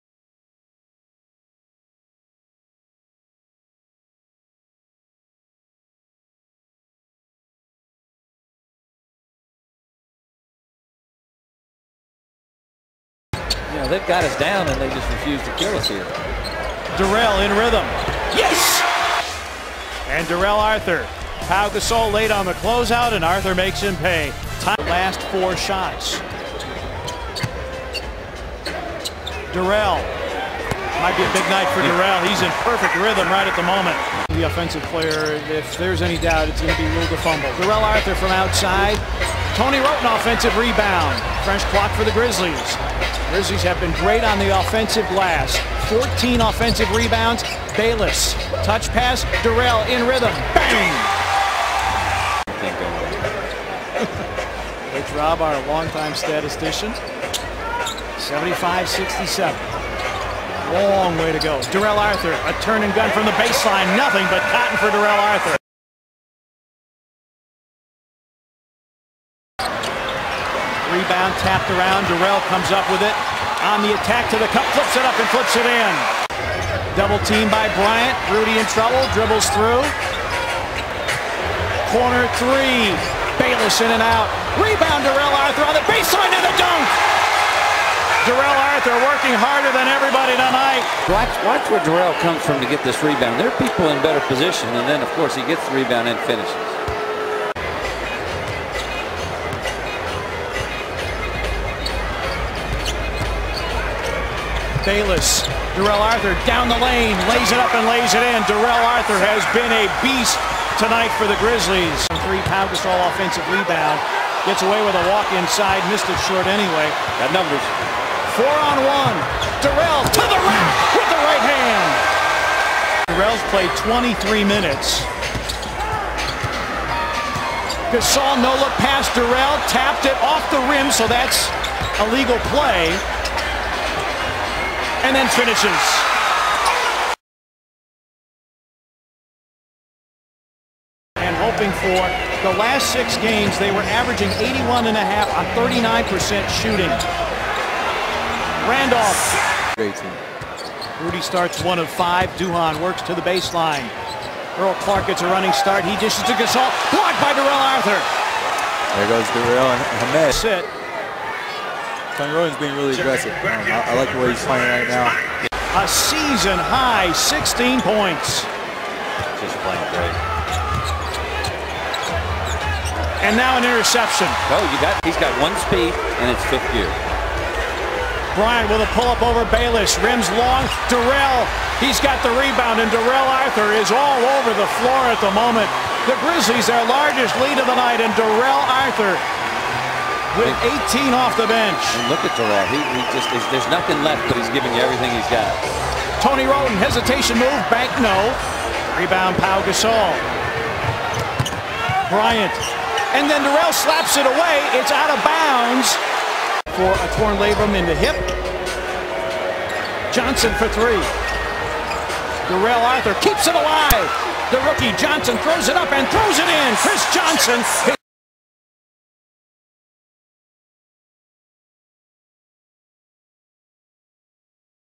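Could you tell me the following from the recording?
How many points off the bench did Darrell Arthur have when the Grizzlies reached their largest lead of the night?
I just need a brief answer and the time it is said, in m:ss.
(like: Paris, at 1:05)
18, at 3:10.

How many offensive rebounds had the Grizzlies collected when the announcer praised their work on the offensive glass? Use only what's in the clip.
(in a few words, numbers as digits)
14.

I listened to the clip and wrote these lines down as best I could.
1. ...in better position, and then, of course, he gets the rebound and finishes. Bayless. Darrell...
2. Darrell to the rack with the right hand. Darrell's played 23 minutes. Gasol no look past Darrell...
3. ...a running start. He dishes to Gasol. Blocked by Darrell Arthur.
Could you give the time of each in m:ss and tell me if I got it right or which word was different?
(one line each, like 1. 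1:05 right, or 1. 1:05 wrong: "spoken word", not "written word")
1. 1:33 right
2. 1:59 right
3. 2:35 right.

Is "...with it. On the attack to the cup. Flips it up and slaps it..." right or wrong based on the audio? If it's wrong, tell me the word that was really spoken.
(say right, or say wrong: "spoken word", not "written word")
wrong: "flips", not "slaps".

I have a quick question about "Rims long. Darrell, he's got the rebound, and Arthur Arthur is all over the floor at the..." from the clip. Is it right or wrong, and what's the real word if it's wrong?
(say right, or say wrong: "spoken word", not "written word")
wrong: "Darrell", not "Arthur".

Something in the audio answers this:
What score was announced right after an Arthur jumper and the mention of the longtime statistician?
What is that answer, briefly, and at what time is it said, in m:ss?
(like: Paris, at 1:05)
75-67, at 0:58.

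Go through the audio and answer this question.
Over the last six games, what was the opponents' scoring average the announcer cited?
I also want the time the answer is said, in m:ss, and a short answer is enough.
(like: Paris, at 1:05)
81.5, at 2:24.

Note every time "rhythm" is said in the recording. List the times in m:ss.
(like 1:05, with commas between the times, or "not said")
0:17, 0:32, 0:50.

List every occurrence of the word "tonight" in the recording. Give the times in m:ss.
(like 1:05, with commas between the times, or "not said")
1:30, 1:50.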